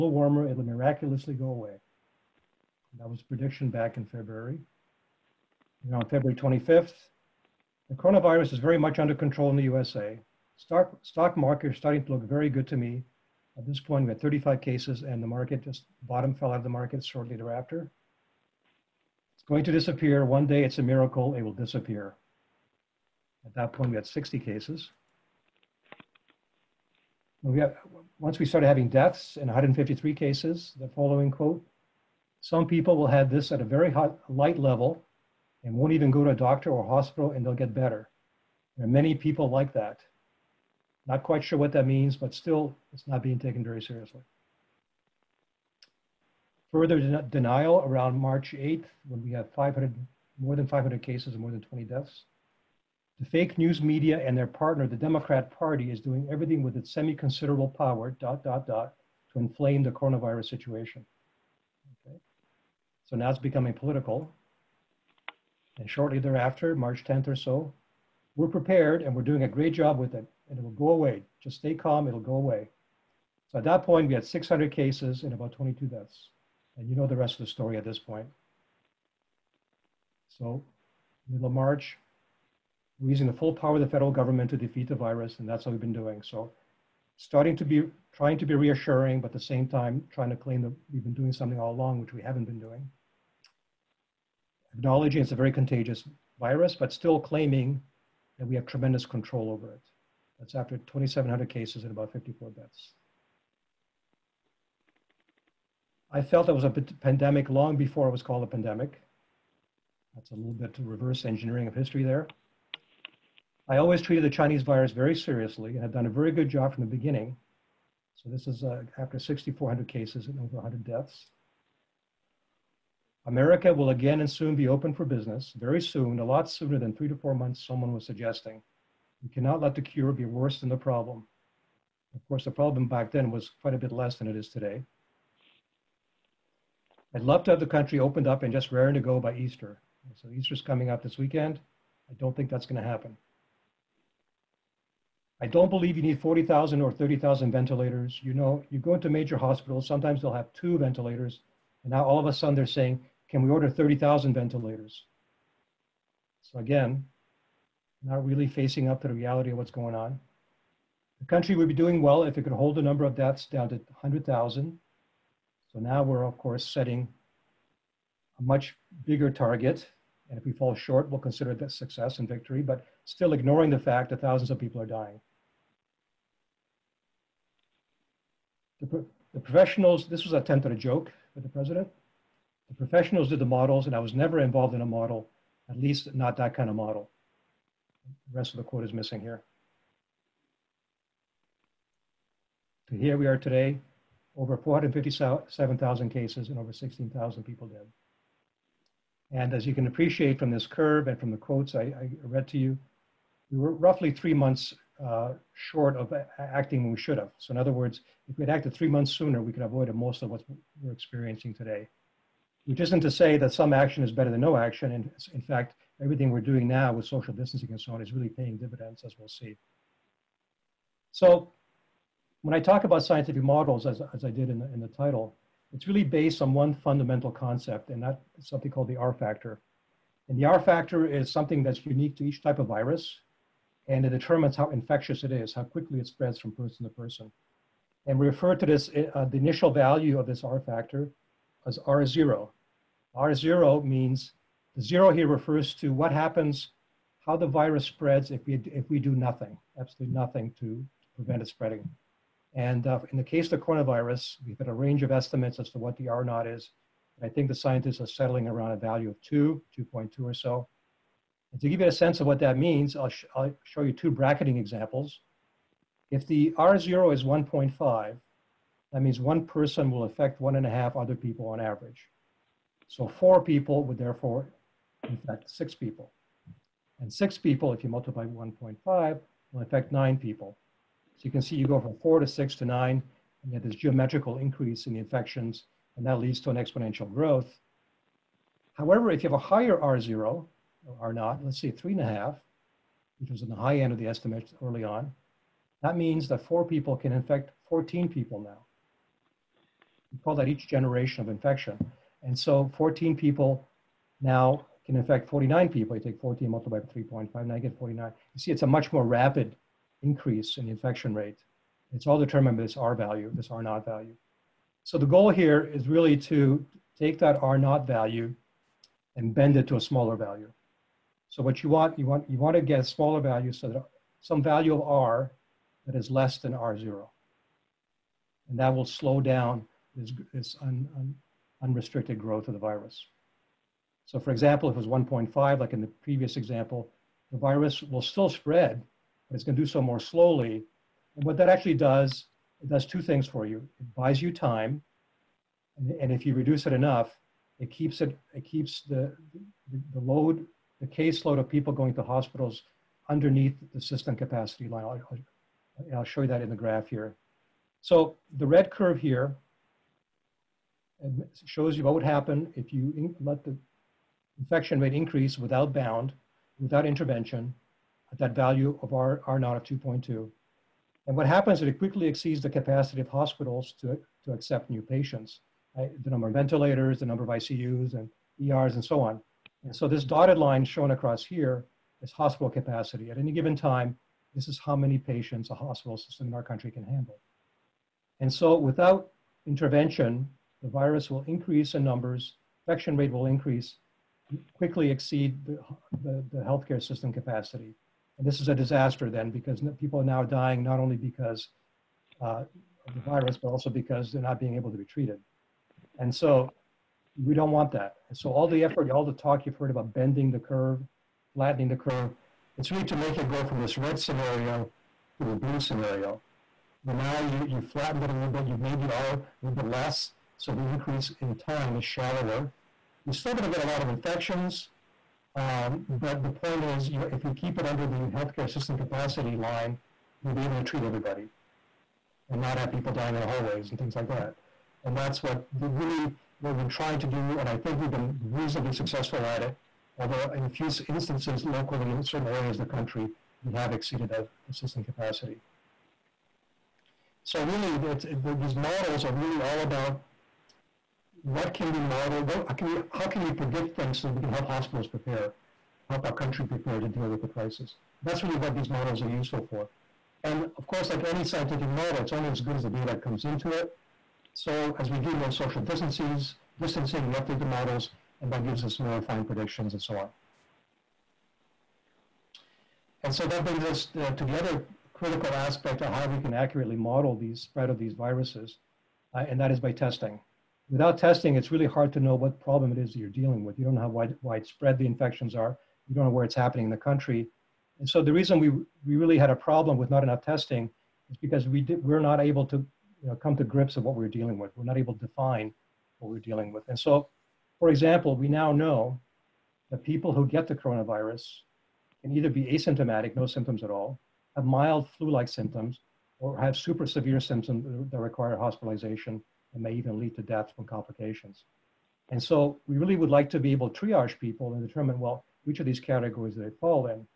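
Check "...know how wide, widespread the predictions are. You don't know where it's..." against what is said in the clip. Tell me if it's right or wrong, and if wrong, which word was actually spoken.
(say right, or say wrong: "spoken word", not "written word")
wrong: "infections", not "predictions".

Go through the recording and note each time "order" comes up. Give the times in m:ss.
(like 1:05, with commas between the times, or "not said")
2:33.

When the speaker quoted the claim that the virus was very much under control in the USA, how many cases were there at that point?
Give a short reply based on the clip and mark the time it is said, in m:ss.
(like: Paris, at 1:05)
35, at 0:14.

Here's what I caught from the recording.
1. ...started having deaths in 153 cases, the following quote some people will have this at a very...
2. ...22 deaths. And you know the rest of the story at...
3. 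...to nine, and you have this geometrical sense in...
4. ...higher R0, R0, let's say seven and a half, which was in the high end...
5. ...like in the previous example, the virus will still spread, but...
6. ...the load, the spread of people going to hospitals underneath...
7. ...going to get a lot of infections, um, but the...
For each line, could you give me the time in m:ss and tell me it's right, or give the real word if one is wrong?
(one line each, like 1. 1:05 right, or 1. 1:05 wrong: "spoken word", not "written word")
1. 0:28 right
2. 1:15 right
3. 4:42 wrong: "increase", not "sense"
4. 4:49 wrong: "three", not "seven"
5. 5:35 right
6. 5:49 wrong: "caseload", not "spread"
7. 7:03 right.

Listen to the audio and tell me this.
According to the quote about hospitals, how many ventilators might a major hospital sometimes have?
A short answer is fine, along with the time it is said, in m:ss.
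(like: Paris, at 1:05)
2, at 2:30.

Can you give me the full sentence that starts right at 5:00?
We call that each generation of infection.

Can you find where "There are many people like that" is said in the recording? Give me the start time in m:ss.
0:38.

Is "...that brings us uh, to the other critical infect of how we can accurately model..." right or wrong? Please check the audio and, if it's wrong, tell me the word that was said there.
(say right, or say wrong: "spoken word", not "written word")
wrong: "aspect", not "infect".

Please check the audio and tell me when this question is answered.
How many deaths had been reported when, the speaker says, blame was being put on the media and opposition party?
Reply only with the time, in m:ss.
0:51.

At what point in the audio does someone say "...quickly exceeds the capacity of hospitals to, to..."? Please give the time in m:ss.
6:11.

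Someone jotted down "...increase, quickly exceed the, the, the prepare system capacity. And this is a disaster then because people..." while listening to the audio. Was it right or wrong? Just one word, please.
wrong.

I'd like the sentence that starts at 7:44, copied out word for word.
So as we do more social distances, distancing, we update the models, and that gives us more refined predictions and so on.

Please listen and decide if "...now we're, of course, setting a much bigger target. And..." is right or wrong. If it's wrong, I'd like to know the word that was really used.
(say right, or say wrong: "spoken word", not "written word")
right.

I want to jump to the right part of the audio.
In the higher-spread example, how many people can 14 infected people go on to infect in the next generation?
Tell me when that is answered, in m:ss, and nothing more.
5:05.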